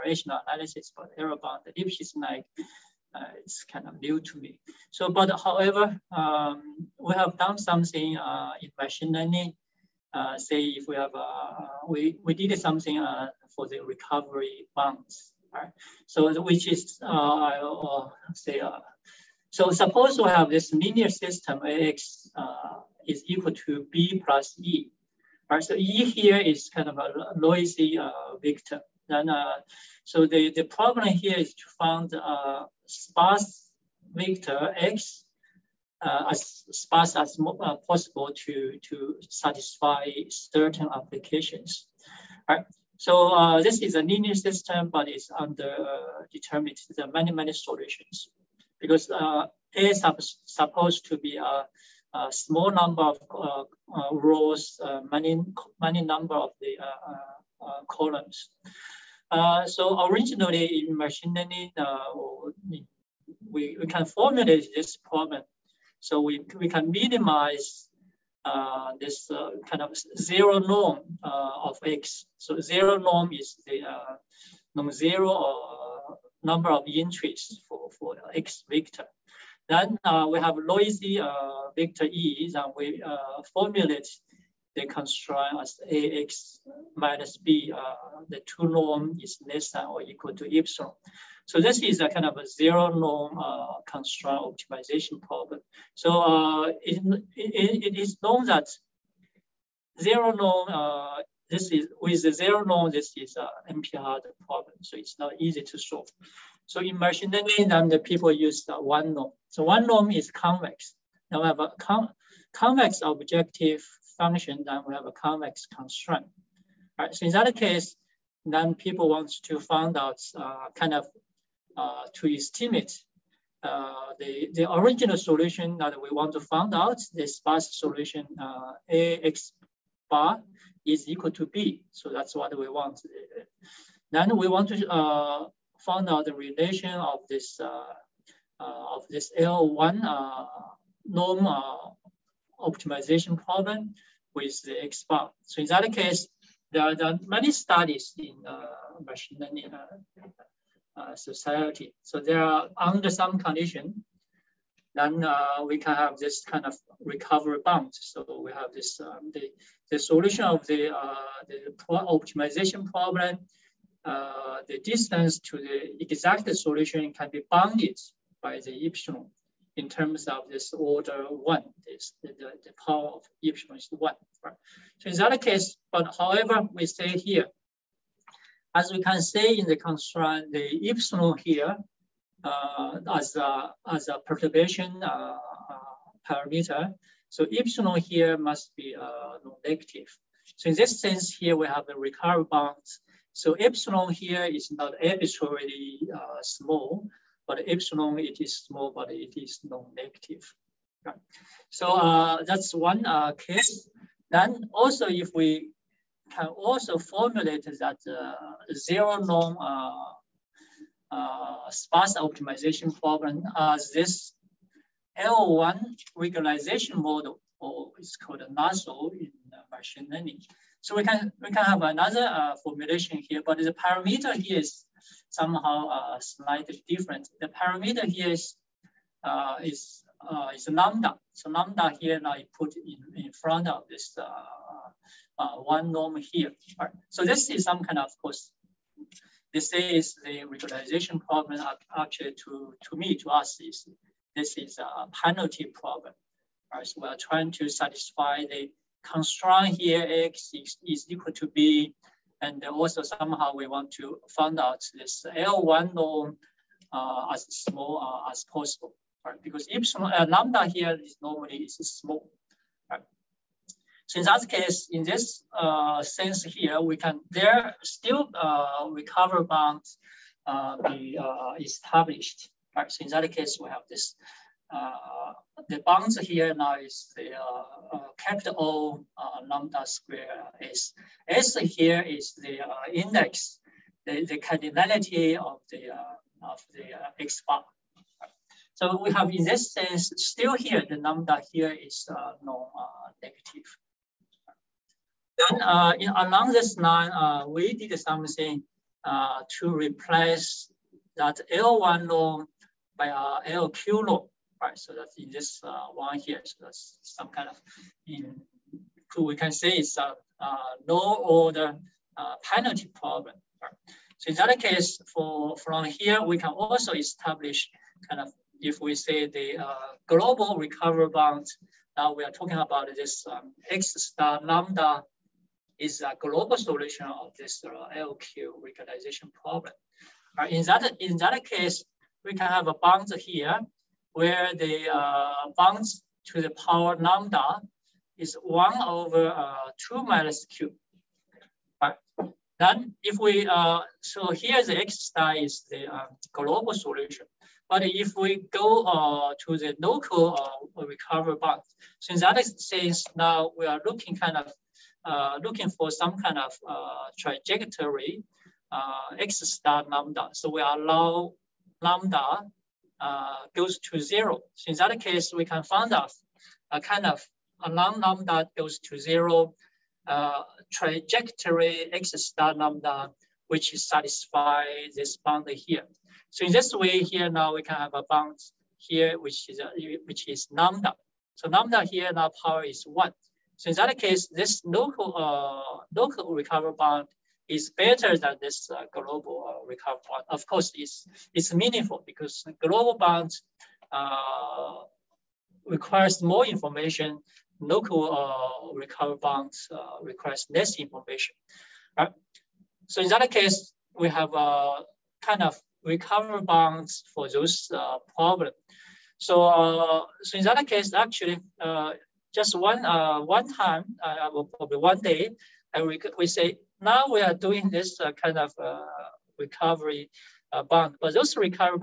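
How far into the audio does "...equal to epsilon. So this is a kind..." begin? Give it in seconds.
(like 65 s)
90 s.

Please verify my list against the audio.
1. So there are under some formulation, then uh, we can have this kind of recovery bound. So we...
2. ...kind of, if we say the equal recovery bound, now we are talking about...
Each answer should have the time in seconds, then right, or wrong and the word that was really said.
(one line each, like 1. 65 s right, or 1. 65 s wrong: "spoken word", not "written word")
1. 152 s wrong: "condition", not "formulation"
2. 318 s wrong: "global", not "equal".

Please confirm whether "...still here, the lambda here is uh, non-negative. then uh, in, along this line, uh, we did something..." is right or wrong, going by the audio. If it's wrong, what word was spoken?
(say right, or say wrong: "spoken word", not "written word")
right.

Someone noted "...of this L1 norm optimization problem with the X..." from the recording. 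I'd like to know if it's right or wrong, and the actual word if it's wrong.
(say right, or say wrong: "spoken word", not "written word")
right.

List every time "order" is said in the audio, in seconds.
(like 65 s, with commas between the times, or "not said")
170 s, 311 s.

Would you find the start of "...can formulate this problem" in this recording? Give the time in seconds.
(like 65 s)
63 s.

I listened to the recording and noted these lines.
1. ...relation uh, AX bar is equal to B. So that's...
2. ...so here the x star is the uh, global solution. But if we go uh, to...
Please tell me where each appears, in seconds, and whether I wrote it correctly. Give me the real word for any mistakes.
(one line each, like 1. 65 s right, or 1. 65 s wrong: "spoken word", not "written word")
1. 127 s wrong: "solution", not "relation"
2. 343 s right.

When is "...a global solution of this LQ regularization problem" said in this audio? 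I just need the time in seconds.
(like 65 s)
326 s.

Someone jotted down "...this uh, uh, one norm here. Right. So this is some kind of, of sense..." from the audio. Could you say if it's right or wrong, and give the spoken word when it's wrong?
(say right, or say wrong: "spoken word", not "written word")
wrong: "course", not "sense".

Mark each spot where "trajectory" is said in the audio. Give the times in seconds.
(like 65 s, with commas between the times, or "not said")
357 s, 370 s.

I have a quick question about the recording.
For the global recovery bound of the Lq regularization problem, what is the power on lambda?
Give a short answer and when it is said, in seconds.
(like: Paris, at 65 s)
1 over 2 minus q, at 338 s.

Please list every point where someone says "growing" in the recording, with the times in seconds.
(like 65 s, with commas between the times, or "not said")
not said.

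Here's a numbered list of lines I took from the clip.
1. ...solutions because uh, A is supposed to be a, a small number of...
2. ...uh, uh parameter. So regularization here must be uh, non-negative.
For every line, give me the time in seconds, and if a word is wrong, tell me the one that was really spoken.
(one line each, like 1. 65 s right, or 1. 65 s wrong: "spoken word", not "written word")
1. 47 s right
2. 185 s wrong: "epsilon", not "regularization".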